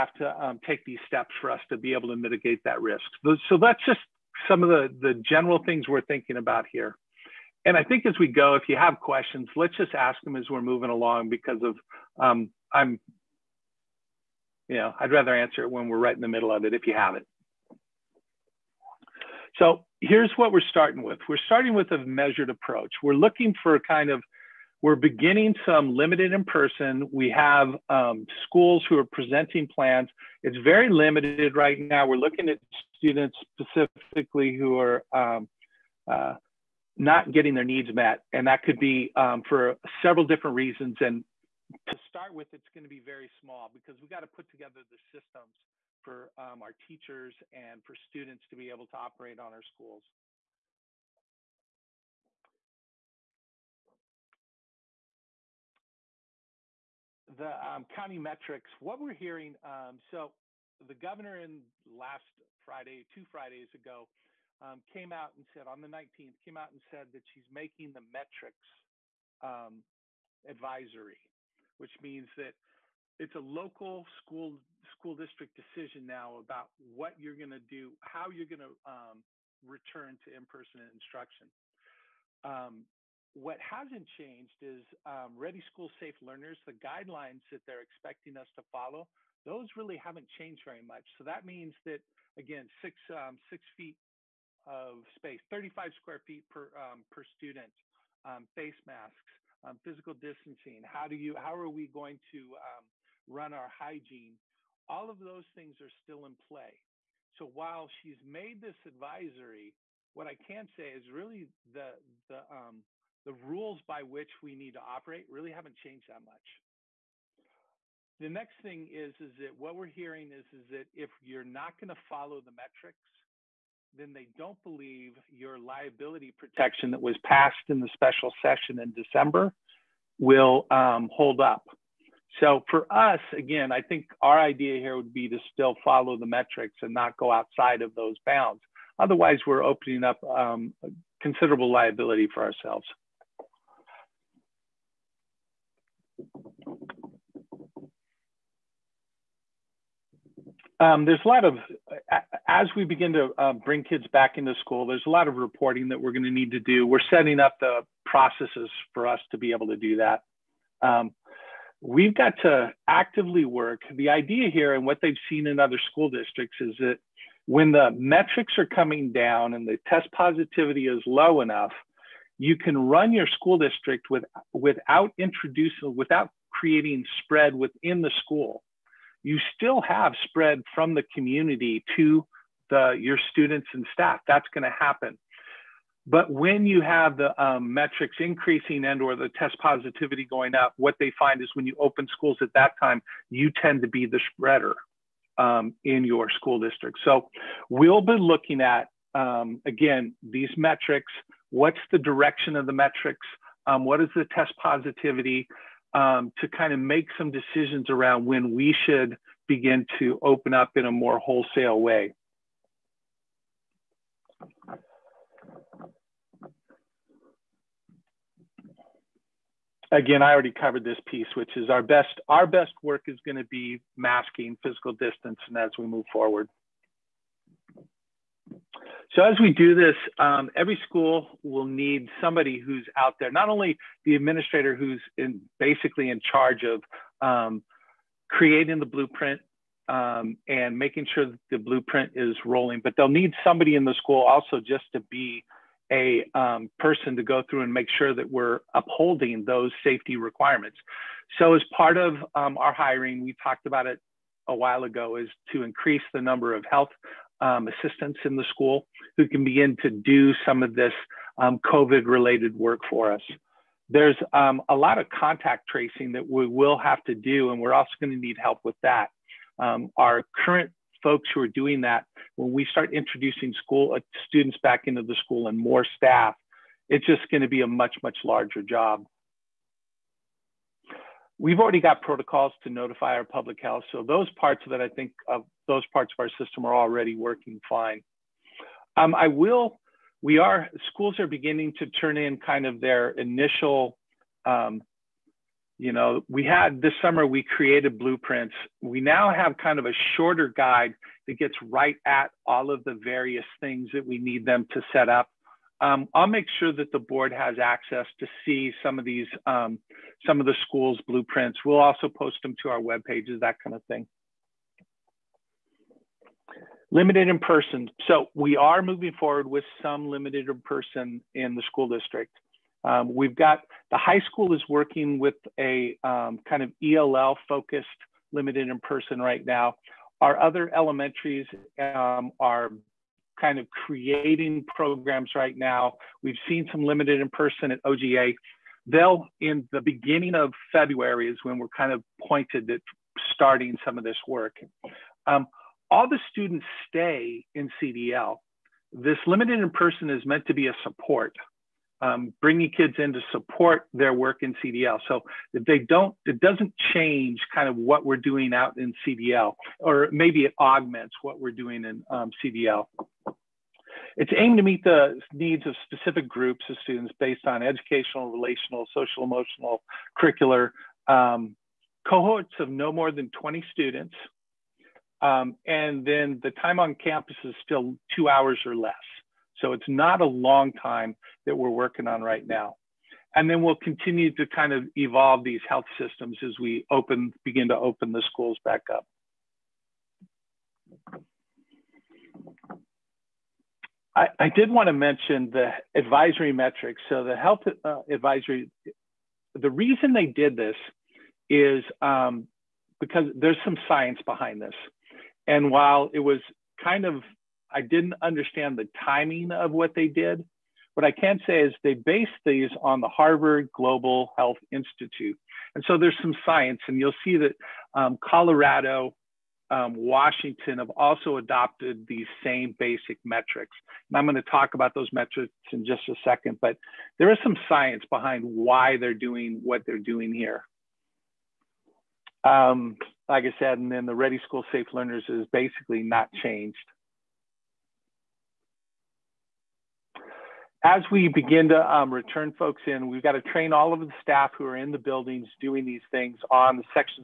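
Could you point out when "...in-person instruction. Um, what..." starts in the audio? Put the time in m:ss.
1:20.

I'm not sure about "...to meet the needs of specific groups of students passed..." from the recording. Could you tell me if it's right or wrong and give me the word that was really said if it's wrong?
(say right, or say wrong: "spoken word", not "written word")
wrong: "based", not "passed".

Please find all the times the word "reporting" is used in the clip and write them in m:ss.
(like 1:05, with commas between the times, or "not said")
2:35.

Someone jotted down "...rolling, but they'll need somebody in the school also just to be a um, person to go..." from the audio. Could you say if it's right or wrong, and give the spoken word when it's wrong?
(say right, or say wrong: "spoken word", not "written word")
right.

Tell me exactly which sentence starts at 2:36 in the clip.
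We're setting up the processes for us to be able to do that.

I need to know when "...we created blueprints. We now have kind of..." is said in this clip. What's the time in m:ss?
4:57.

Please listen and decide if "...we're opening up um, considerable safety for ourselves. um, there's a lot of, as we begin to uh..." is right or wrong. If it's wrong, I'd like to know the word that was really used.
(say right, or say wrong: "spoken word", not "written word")
wrong: "liability", not "safety".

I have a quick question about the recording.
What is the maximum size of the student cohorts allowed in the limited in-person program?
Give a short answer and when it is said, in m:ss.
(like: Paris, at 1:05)
20 students, at 6:12.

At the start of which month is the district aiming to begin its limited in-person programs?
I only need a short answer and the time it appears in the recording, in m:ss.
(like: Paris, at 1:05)
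February, at 5:40.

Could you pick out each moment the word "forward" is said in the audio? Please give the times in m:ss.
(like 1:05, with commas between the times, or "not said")
3:46, 5:19.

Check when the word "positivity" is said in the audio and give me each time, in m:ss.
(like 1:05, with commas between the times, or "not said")
2:50, 3:09, 3:24.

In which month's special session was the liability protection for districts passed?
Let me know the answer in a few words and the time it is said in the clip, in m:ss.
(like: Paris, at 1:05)
December, at 2:09.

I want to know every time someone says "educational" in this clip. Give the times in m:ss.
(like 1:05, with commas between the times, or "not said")
6:07.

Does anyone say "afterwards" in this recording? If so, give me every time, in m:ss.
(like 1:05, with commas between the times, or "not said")
not said.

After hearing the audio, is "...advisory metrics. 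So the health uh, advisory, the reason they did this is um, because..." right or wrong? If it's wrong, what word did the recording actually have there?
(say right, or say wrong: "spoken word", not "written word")
right.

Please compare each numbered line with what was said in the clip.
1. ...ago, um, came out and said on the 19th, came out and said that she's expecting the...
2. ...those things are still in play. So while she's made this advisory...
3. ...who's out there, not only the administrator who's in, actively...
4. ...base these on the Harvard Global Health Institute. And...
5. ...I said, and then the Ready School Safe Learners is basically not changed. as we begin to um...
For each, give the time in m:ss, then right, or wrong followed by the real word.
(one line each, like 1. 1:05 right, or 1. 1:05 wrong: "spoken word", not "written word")
1. 1:03 wrong: "making", not "expecting"
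2. 1:45 right
3. 3:52 wrong: "basically", not "actively"
4. 6:51 right
5. 7:13 right.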